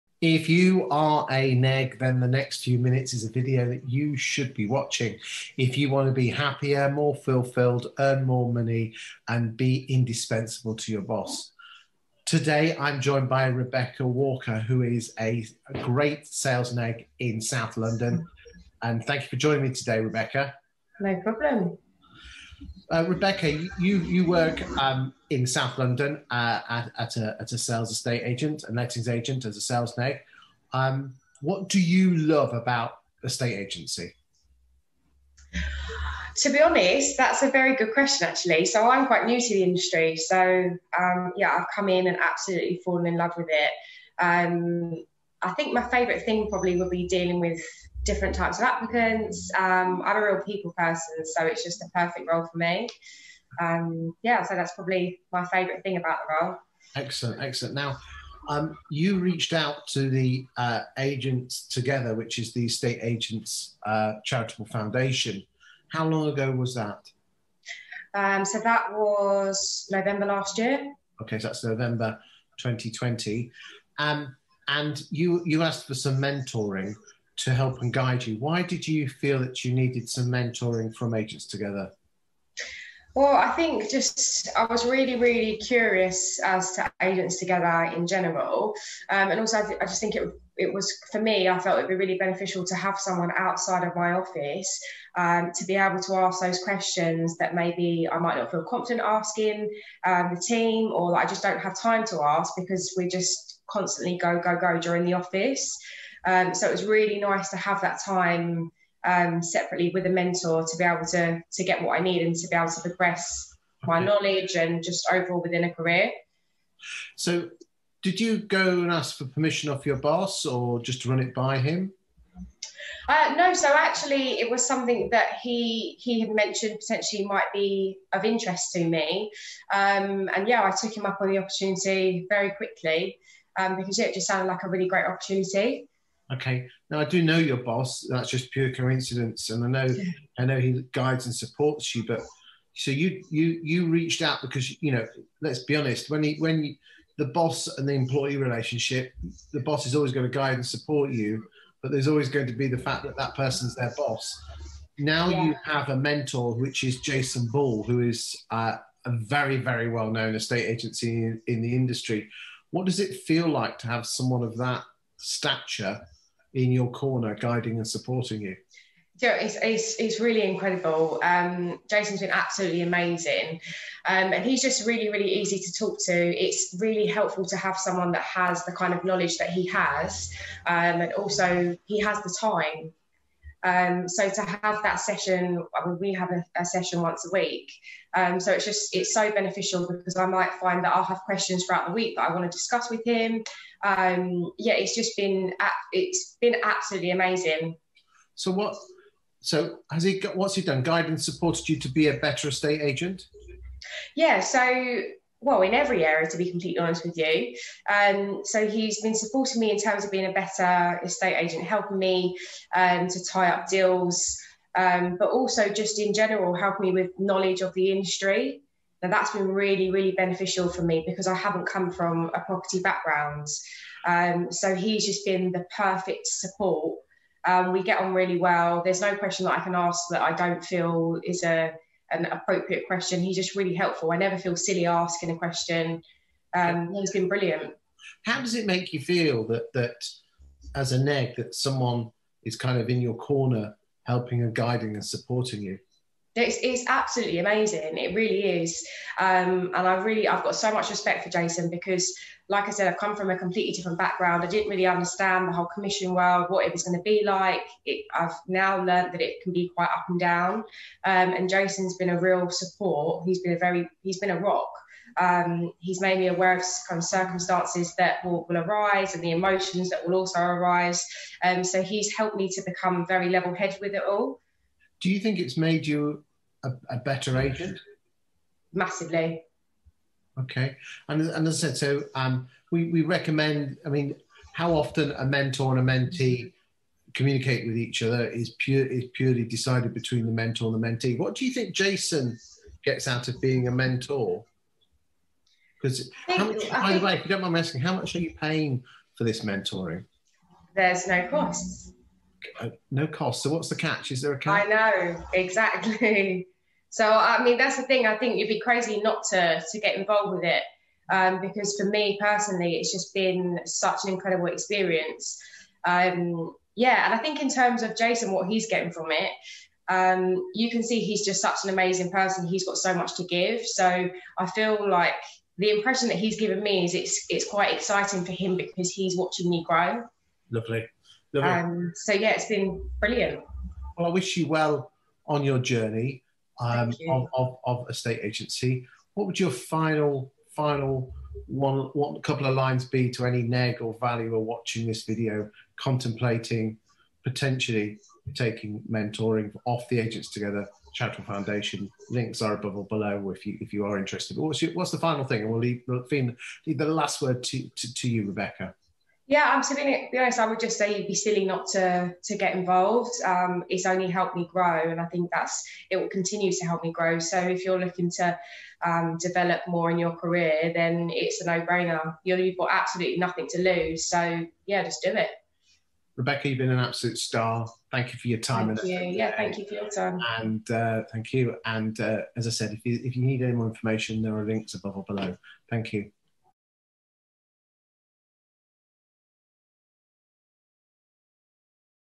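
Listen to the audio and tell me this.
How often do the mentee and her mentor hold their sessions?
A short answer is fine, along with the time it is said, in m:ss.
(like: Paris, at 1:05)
Once a week, at 3:07.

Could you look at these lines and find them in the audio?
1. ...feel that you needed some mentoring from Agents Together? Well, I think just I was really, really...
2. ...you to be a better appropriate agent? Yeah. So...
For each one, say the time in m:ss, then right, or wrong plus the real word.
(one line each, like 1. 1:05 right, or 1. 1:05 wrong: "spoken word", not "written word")
1. 1:19 right
2. 3:21 wrong: "estate", not "appropriate".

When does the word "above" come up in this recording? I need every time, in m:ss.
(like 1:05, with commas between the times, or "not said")
5:52, 6:24.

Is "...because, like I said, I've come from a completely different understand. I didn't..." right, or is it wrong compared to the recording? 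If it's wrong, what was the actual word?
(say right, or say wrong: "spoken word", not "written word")
wrong: "background", not "understand".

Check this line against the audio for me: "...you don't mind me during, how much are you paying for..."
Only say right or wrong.
wrong.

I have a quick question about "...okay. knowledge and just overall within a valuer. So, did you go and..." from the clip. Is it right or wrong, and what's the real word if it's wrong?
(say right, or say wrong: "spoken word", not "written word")
wrong: "career", not "valuer".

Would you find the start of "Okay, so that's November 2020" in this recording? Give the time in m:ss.
1:11.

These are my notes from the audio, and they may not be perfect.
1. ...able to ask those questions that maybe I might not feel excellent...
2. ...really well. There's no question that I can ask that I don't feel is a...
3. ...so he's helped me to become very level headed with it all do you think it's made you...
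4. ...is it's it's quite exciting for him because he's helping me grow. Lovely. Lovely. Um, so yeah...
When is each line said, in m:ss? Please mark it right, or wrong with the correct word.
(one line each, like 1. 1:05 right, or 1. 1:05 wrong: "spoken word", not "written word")
1. 1:35 wrong: "confident", not "excellent"
2. 3:48 right
3. 4:31 right
4. 5:26 wrong: "watching", not "helping".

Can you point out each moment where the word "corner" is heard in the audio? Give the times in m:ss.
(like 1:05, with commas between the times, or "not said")
2:46, 4:03.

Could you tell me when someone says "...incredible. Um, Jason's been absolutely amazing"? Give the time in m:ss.
2:50.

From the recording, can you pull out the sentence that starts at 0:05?
If you want to be happier, more fulfilled, earn more money, and be indispensable to your boss.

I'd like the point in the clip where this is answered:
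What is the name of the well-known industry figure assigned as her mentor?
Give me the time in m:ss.
2:37.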